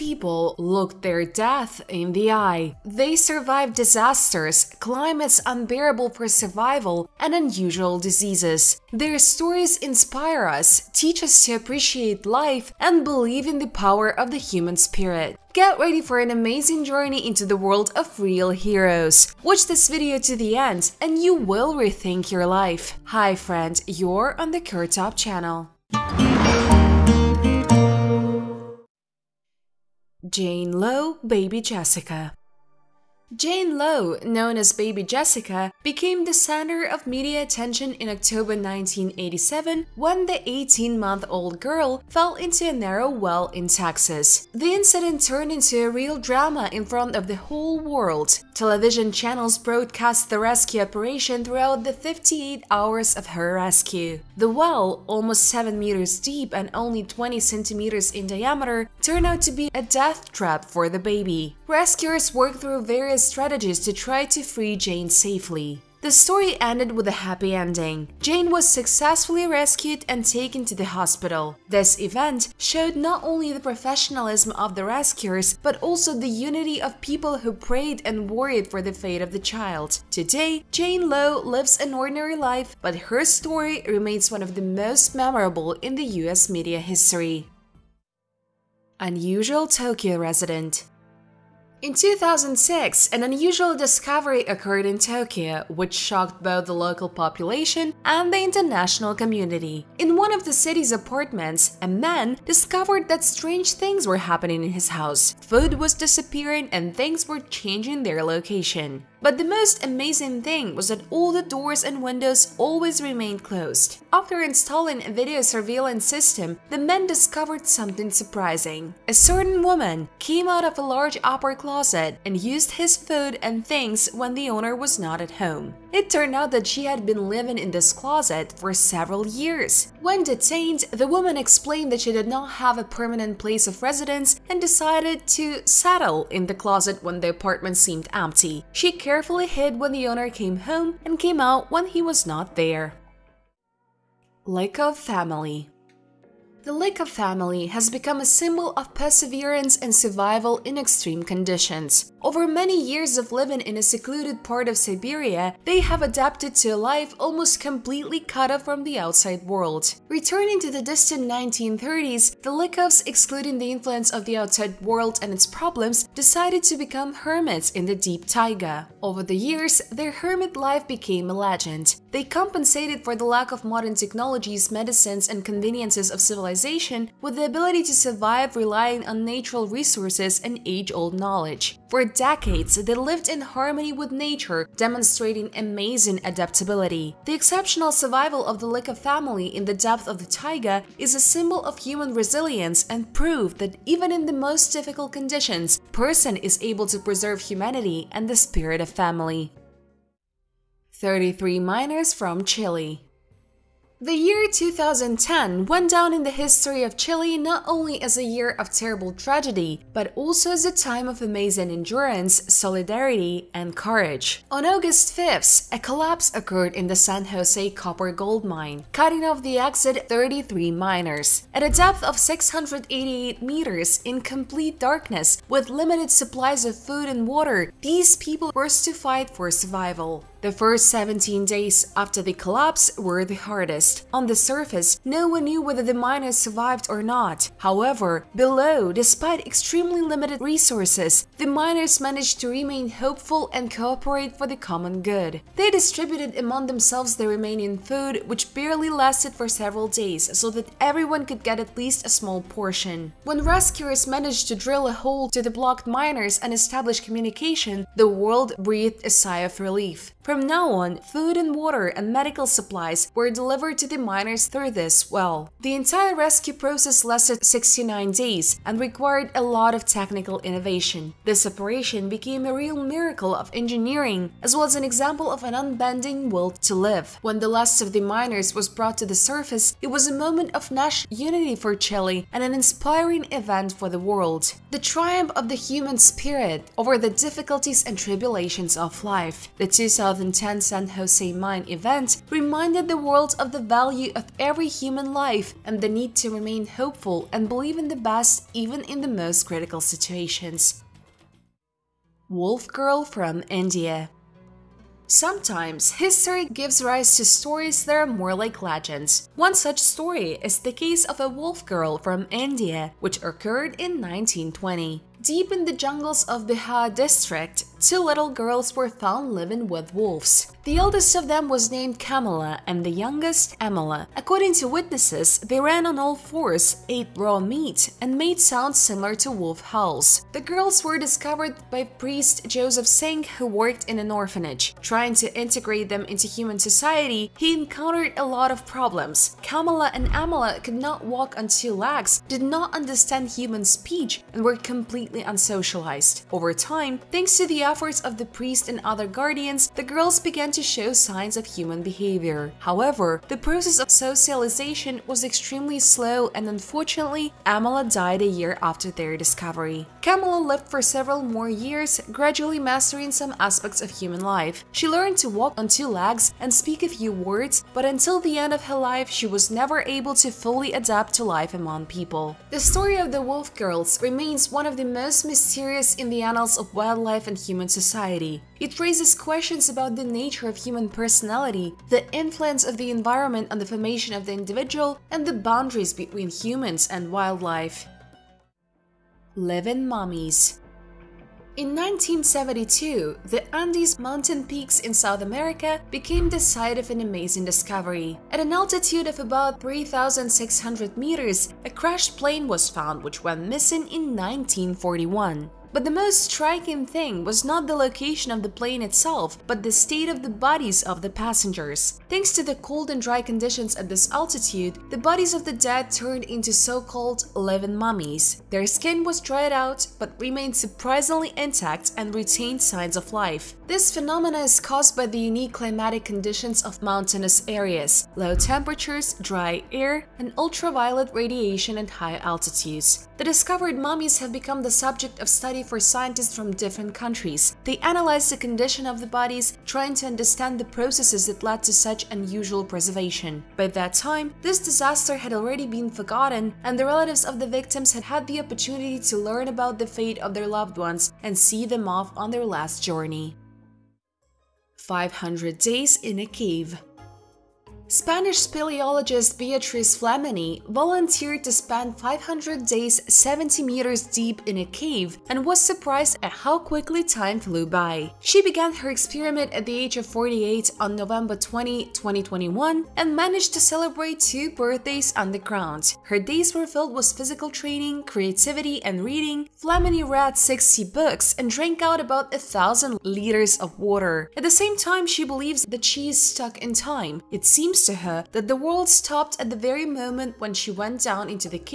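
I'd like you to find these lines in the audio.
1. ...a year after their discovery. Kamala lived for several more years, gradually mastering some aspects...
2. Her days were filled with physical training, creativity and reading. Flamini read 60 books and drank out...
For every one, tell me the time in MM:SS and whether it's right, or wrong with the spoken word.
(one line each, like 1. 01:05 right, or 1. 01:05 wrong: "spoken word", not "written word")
1. 05:58 right
2. 07:56 right.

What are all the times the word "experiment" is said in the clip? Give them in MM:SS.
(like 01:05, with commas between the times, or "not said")
07:48.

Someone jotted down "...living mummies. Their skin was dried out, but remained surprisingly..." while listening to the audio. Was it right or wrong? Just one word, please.
right.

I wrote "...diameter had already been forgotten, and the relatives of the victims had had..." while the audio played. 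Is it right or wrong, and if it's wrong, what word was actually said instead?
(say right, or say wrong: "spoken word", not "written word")
wrong: "disaster", not "diameter".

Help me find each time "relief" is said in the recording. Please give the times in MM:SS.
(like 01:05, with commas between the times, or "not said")
04:19.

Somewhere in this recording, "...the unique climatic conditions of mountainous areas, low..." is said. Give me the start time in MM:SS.
07:05.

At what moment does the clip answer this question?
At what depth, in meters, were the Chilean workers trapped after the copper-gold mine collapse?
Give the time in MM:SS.
03:42.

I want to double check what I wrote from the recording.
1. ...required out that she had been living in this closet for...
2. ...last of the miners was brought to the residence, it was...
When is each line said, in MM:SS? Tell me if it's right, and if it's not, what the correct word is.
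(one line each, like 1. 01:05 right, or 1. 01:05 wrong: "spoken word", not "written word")
1. 02:06 wrong: "turned", not "required"
2. 04:37 wrong: "surface", not "residence".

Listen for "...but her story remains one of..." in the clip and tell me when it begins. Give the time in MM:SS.
01:22.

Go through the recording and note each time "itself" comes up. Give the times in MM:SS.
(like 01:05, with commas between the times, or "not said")
06:48.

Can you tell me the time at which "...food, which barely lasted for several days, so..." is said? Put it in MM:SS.
04:07.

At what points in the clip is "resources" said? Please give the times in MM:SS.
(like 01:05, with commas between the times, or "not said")
02:59, 04:00.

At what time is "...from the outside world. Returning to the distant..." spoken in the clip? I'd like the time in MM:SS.
02:38.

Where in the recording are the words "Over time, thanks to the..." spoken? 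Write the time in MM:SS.
05:46.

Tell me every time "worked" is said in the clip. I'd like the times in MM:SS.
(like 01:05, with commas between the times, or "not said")
01:02, 05:33.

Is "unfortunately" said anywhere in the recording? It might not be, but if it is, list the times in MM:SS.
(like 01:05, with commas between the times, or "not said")
05:56.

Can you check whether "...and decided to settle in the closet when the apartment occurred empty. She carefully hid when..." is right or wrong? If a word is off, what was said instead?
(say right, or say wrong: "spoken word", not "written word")
wrong: "seemed", not "occurred".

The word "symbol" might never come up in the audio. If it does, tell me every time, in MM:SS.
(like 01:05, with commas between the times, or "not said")
02:28, 03:11.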